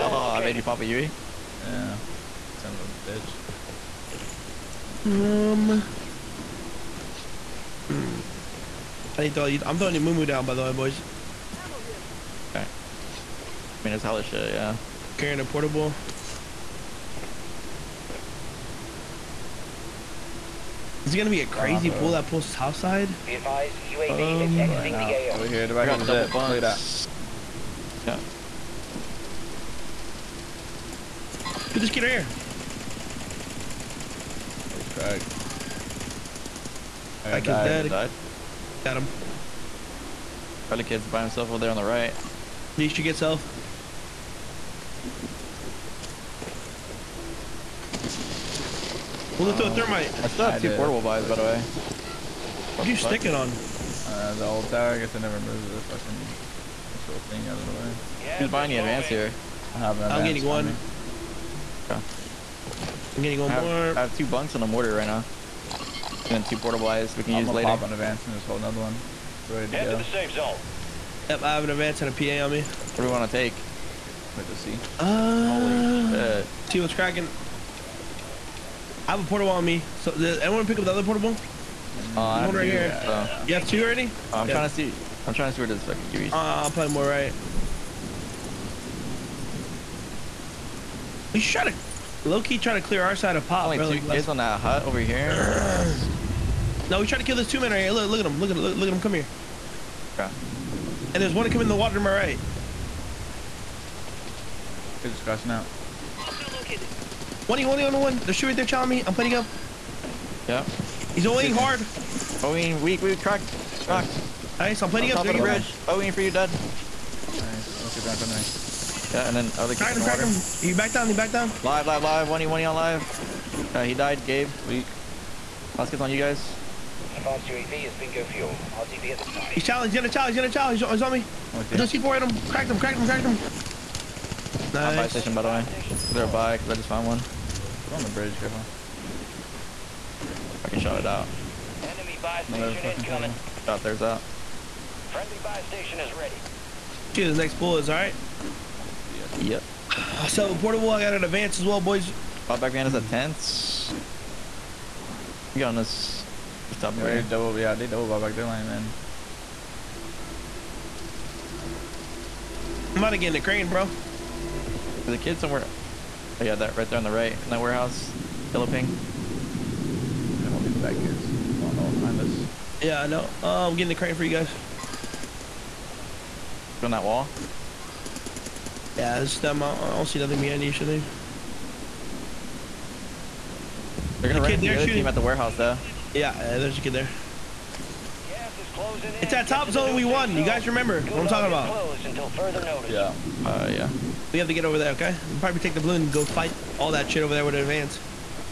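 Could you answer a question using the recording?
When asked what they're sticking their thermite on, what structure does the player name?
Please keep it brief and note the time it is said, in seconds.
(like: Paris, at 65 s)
the old tower, at 54 s.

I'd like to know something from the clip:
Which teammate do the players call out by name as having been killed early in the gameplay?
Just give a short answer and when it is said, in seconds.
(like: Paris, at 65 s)
Craig, at 37 s.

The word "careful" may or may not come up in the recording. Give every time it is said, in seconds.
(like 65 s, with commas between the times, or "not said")
138 s.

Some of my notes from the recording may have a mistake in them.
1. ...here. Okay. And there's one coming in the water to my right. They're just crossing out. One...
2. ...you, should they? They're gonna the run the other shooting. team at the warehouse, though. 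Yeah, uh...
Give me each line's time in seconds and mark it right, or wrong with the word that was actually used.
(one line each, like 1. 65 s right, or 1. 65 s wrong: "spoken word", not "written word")
1. 99 s right
2. 180 s right.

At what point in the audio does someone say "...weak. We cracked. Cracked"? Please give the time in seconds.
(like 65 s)
112 s.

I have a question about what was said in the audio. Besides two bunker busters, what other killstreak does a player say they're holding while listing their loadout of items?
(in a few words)
a mortar.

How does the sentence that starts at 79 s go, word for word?
So, did anyone pick up the other portable?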